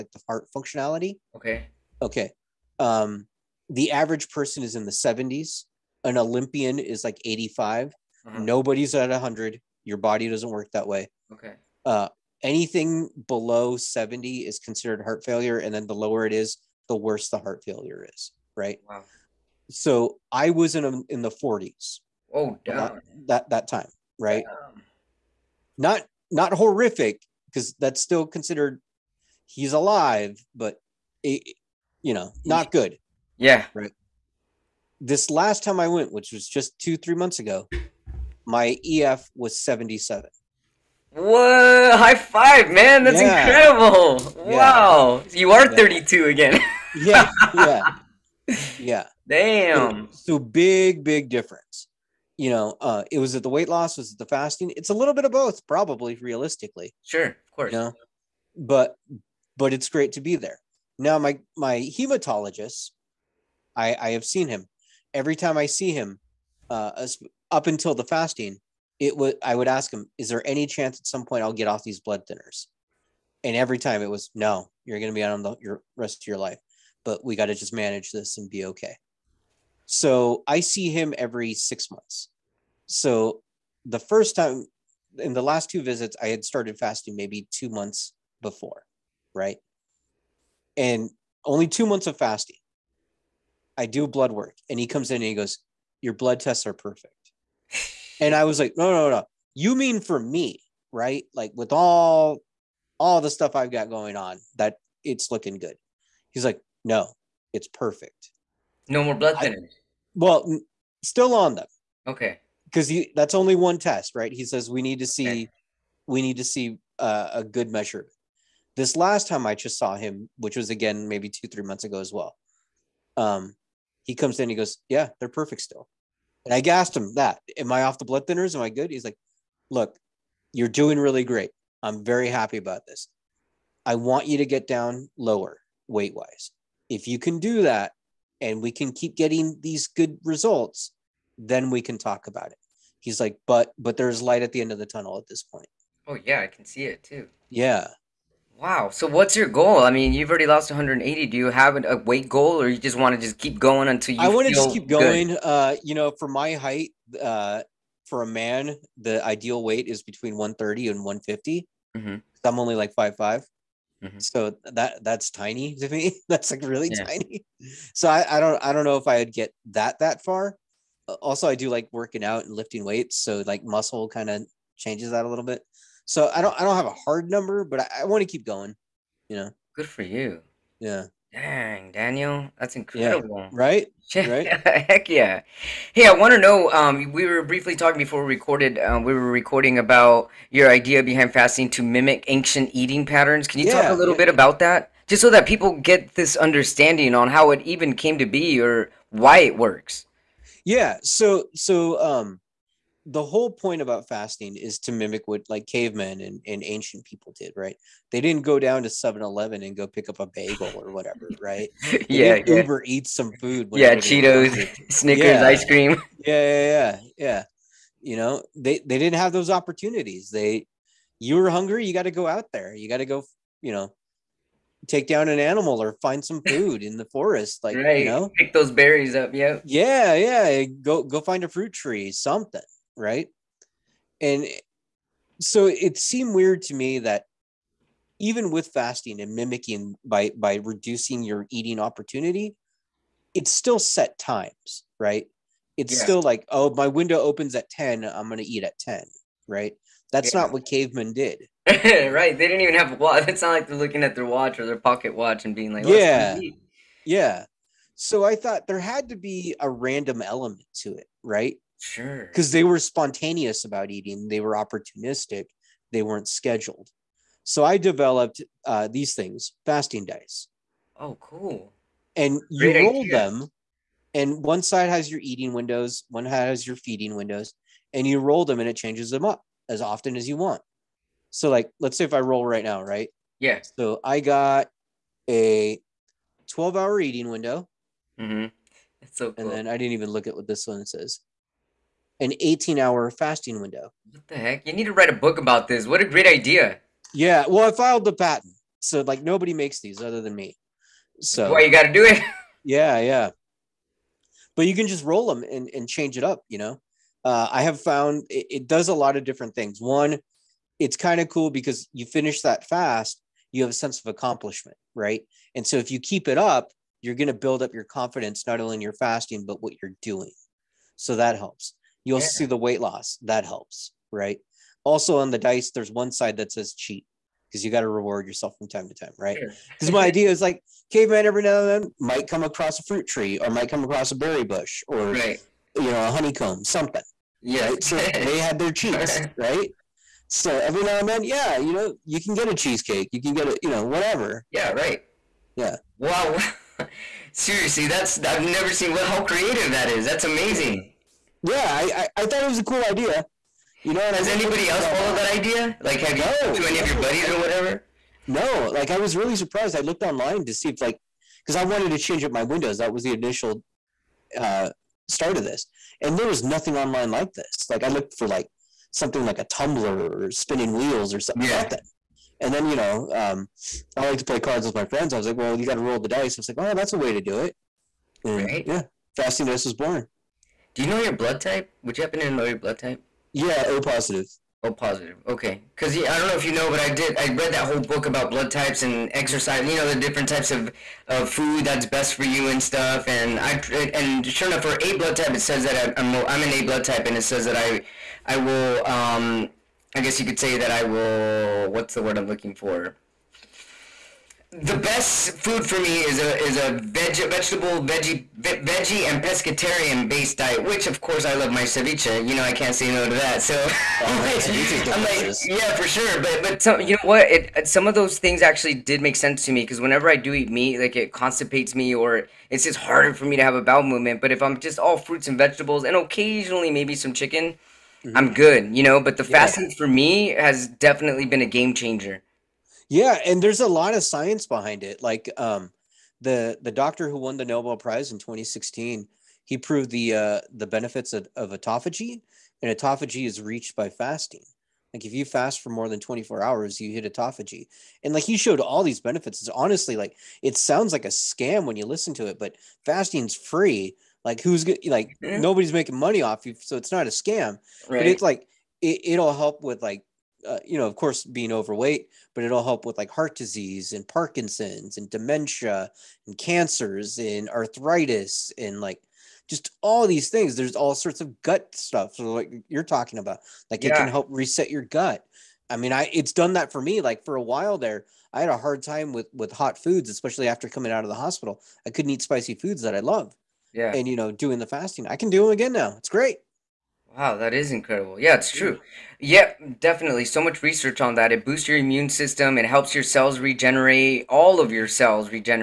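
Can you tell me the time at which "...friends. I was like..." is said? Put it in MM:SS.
06:14.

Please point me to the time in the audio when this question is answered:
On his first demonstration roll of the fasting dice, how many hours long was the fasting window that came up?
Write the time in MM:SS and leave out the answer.
04:52.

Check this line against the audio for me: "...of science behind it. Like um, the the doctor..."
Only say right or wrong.
right.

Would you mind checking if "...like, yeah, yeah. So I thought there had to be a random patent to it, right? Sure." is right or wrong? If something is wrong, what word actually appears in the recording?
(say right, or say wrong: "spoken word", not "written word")
wrong: "element", not "patent".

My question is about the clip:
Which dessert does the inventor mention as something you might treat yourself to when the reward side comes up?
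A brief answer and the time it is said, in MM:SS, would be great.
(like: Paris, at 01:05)
Cheesecake, at 05:42.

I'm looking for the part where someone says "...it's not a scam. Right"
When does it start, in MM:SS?
07:36.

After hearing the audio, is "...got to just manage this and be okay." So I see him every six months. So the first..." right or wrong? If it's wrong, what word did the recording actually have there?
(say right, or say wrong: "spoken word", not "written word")
right.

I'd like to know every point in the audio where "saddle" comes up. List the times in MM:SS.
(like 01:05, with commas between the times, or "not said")
not said.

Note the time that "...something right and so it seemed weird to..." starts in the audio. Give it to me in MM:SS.
03:52.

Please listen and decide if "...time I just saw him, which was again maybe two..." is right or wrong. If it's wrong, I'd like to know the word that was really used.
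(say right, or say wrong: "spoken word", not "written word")
right.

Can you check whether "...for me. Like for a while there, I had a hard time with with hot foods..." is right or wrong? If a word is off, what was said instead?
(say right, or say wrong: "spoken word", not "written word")
right.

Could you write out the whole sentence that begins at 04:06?
still like oh my window opens at 10 i'm going to eat at 10 right that's yeah.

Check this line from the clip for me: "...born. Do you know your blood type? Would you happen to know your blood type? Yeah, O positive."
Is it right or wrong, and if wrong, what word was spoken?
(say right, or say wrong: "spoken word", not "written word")
right.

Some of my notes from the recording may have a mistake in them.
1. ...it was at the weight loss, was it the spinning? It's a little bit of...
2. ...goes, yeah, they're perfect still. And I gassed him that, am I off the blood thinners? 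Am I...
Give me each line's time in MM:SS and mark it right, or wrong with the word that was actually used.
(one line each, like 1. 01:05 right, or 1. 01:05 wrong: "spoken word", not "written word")
1. 00:53 wrong: "fasting", not "spinning"
2. 02:04 right.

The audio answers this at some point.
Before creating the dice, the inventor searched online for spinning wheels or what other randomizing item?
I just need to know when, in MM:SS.
06:09.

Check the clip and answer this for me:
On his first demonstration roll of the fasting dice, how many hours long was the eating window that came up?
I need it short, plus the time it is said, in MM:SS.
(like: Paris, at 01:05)
12, at 04:46.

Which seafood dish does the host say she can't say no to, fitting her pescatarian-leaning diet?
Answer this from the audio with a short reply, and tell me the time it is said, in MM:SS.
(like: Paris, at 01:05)
Ceviche, at 06:51.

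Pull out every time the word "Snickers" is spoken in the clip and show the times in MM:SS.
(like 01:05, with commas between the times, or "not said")
03:34.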